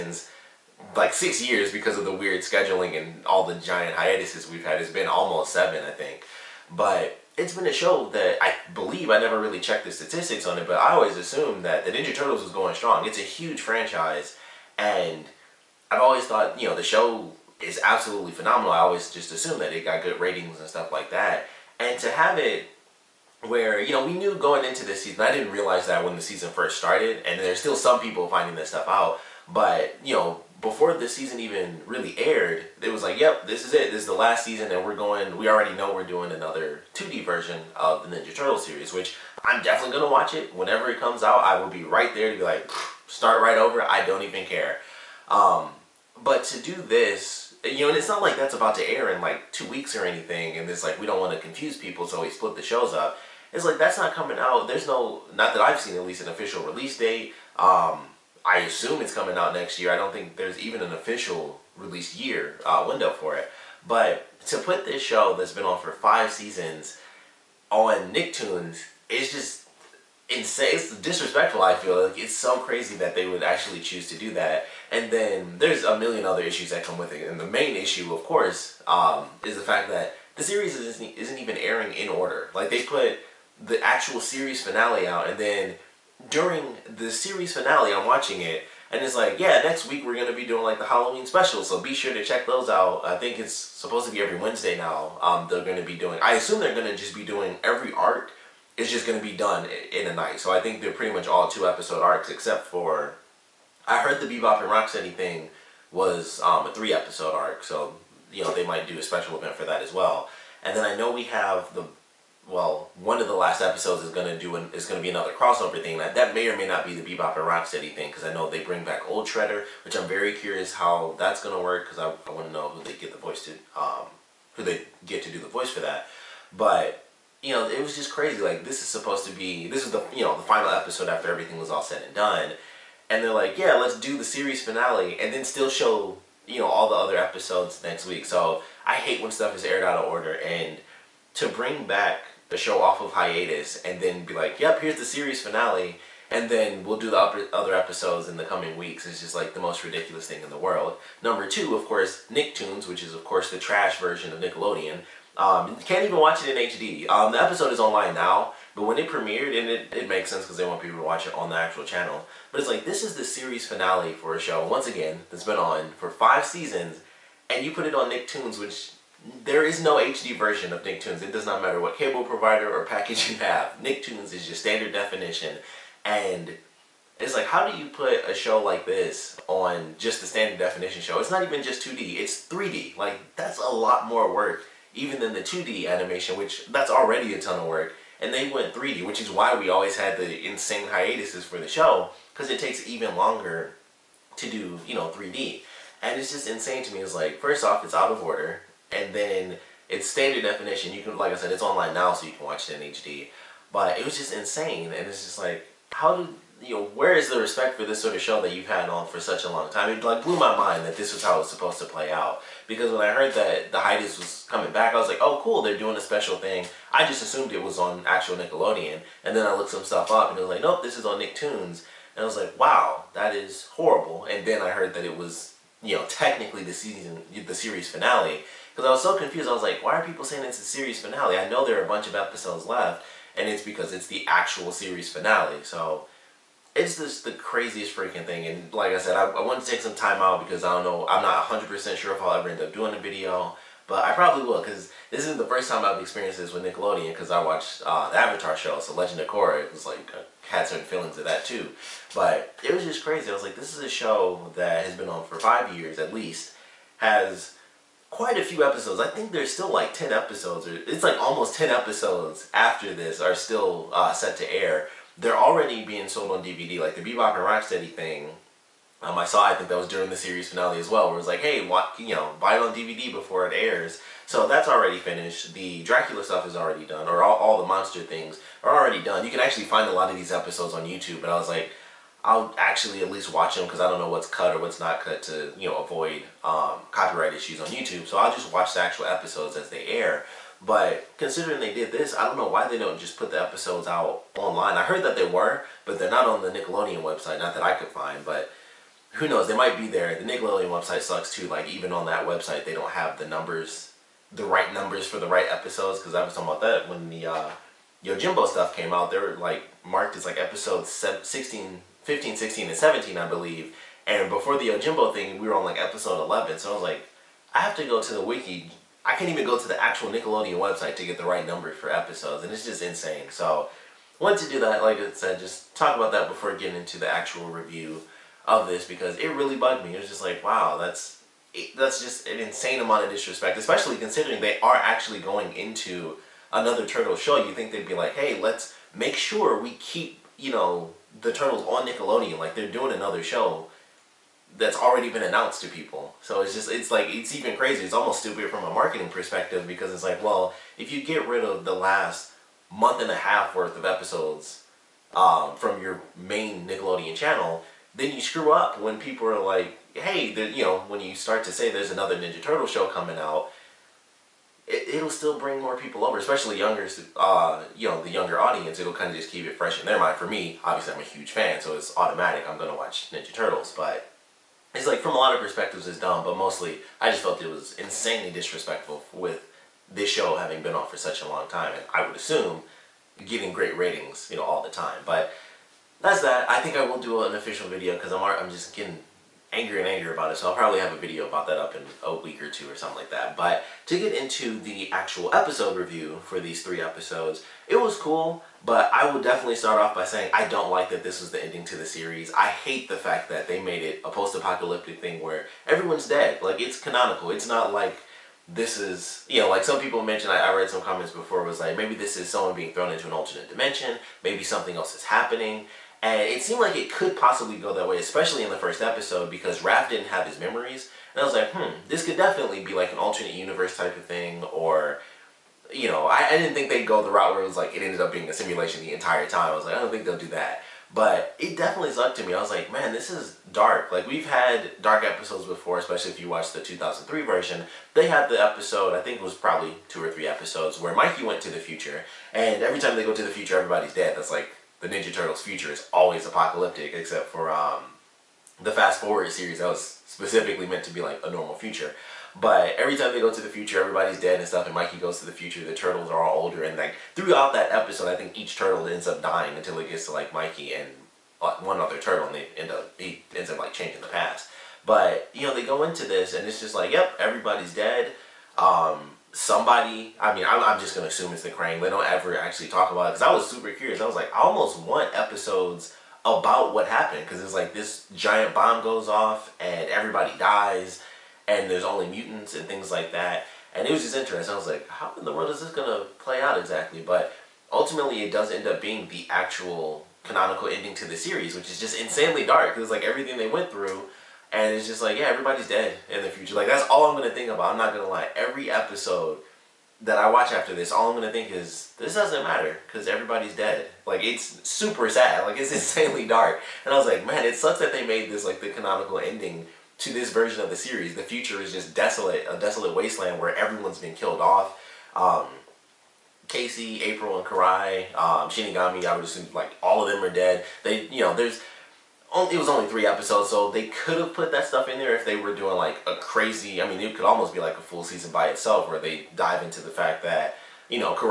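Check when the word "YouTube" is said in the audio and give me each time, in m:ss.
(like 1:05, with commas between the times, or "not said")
4:40, 4:47.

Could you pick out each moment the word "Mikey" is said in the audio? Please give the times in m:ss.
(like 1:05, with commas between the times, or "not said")
7:20, 7:34, 7:40.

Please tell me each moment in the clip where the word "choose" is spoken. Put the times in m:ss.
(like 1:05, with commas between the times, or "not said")
1:13.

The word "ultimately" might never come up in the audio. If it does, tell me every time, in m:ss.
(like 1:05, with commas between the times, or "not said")
8:07.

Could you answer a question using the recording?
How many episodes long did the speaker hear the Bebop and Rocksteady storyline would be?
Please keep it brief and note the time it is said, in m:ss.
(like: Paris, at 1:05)
3, at 1:46.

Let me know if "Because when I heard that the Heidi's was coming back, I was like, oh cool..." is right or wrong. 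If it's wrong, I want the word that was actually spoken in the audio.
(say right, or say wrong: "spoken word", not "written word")
right.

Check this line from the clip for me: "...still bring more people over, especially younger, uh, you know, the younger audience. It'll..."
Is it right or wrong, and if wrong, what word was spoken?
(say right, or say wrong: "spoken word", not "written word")
right.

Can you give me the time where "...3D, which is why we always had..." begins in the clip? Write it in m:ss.
3:08.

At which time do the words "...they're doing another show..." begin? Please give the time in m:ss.
5:42.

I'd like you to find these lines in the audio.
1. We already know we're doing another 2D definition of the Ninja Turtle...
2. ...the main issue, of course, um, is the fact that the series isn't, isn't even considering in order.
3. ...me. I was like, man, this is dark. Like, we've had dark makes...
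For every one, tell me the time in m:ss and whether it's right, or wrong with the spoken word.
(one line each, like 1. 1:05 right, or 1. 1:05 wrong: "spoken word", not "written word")
1. 0:35 wrong: "version", not "definition"
2. 1:17 wrong: "airing", not "considering"
3. 7:12 wrong: "episodes", not "makes".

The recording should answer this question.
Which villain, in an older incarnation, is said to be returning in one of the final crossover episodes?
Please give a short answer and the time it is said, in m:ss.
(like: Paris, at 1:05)
Old Shredder, at 1:59.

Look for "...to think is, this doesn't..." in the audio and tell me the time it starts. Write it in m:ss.
8:21.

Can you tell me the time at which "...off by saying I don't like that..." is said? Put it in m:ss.
6:39.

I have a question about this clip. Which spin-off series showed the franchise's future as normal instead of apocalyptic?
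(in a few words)
Fast Forward.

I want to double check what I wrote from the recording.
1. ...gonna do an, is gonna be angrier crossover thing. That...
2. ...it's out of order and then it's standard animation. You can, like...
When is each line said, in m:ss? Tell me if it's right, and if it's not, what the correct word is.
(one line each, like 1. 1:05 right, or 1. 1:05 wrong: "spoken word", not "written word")
1. 1:54 wrong: "another", not "angrier"
2. 3:17 wrong: "definition", not "animation".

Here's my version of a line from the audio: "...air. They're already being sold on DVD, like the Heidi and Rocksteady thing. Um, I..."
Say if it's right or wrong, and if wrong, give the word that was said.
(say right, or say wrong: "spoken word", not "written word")
wrong: "Bebop", not "Heidi".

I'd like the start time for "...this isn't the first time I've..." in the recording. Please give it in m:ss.
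4:05.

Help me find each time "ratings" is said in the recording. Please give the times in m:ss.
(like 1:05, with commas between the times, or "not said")
0:20, 6:23.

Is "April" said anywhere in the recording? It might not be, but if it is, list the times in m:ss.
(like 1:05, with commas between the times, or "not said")
8:37.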